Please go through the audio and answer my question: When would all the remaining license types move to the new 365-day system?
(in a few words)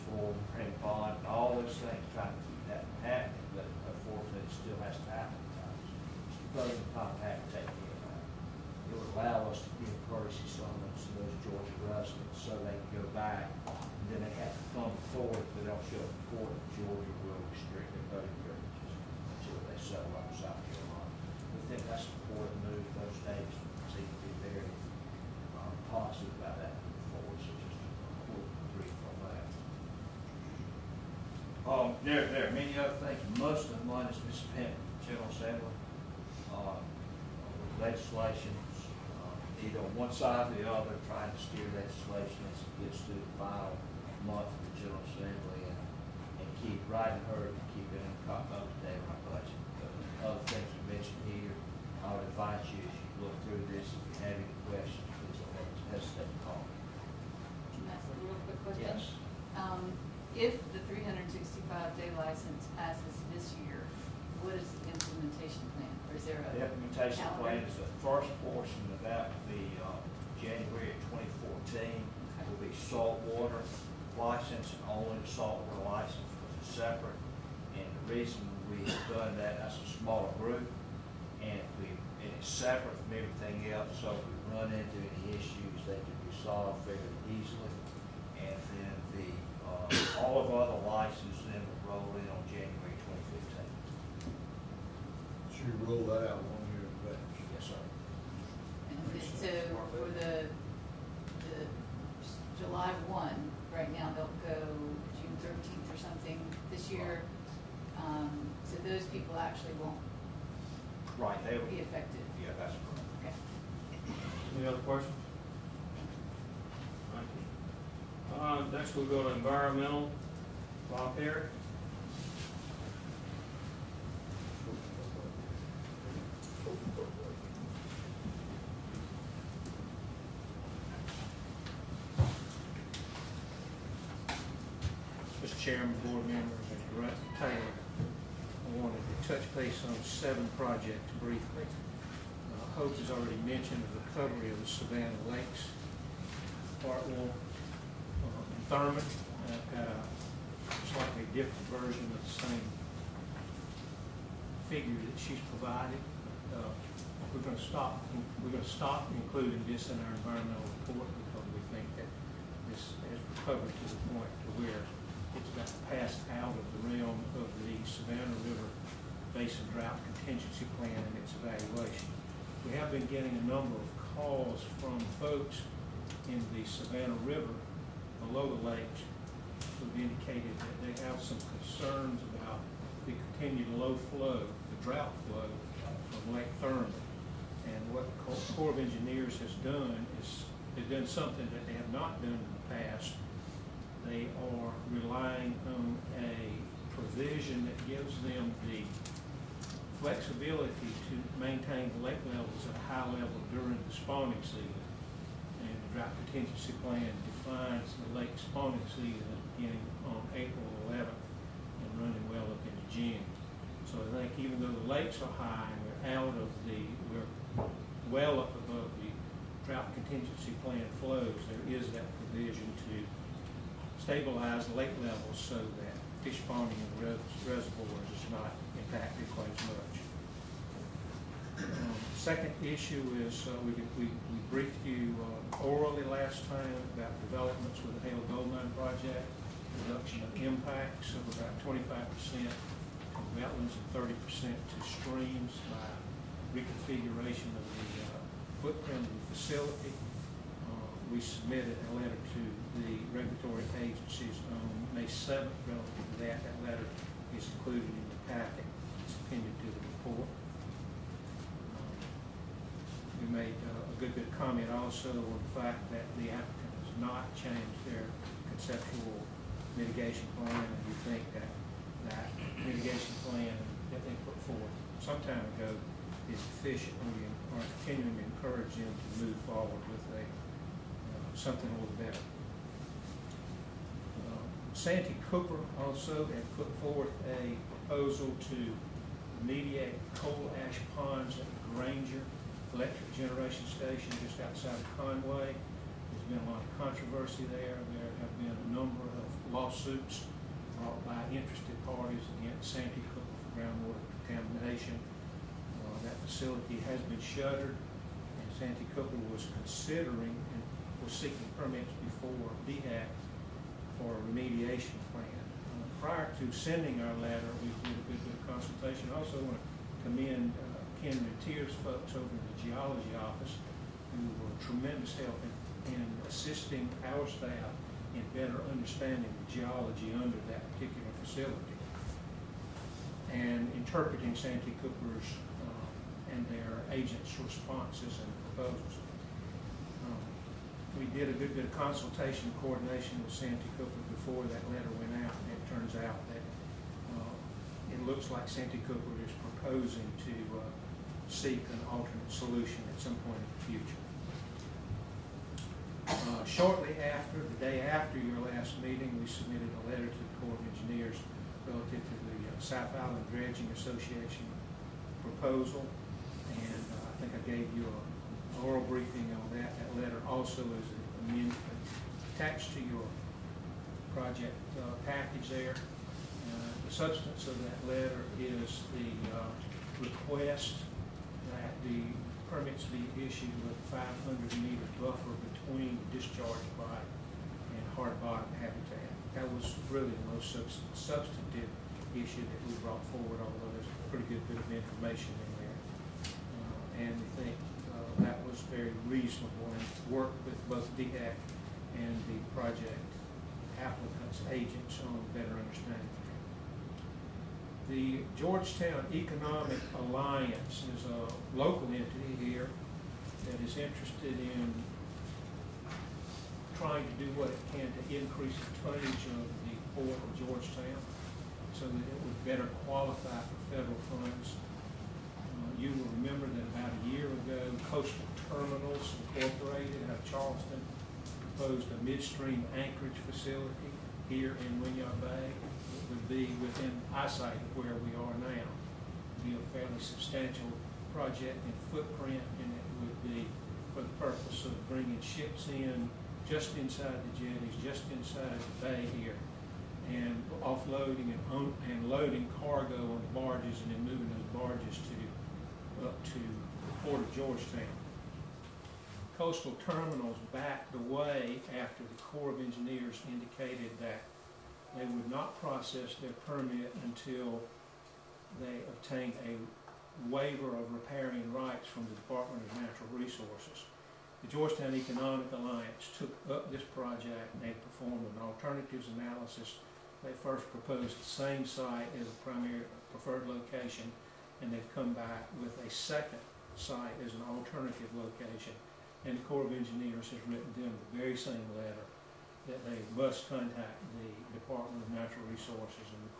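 January 2015.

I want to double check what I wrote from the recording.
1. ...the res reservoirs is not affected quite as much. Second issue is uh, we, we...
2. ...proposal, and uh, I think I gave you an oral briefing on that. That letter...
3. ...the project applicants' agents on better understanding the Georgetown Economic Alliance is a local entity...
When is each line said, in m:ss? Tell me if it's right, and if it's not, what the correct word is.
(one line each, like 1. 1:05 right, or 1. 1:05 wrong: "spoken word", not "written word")
1. 3:47 wrong: "impacted", not "affected"
2. 6:05 right
3. 6:42 right.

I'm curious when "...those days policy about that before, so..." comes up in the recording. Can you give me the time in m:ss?
0:22.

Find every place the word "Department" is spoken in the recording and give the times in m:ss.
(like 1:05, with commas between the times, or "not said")
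7:52, 8:14.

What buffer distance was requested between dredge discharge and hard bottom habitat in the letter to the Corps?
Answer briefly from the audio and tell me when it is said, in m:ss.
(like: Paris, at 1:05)
500 meters, at 6:23.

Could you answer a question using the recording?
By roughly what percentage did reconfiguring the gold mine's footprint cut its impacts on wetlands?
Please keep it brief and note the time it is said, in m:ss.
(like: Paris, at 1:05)
25%, at 4:01.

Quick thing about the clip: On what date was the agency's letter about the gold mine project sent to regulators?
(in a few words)
May 7.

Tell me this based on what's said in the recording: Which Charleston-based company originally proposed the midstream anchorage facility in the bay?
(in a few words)
Coastal Terminals Incorporated.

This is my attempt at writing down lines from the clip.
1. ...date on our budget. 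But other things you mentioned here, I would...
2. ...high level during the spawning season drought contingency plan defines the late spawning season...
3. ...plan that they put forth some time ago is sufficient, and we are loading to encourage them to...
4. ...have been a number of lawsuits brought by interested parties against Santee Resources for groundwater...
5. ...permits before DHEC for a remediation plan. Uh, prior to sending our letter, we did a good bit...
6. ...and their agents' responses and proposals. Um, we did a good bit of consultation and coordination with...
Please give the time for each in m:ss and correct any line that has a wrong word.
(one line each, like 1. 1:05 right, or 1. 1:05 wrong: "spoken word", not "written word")
1. 0:48 right
2. 3:22 right
3. 4:33 wrong: "continuing", not "loading"
4. 4:58 wrong: "Cooper", not "Resources"
5. 5:11 right
6. 5:36 right.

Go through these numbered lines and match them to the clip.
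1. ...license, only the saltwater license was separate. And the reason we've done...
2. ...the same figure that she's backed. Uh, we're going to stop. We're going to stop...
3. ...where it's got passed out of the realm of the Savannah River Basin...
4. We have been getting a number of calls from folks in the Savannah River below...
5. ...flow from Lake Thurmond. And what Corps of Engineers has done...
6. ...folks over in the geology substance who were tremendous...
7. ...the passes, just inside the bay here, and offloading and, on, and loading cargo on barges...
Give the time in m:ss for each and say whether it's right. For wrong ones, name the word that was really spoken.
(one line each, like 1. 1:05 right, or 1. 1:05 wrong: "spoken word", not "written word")
1. 1:14 right
2. 2:32 wrong: "provided", not "backed"
3. 2:44 right
4. 2:52 right
5. 3:05 right
6. 5:21 wrong: "office", not "substance"
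7. 7:27 wrong: "jetties", not "passes".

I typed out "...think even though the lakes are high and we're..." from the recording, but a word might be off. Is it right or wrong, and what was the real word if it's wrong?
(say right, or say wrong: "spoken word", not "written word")
right.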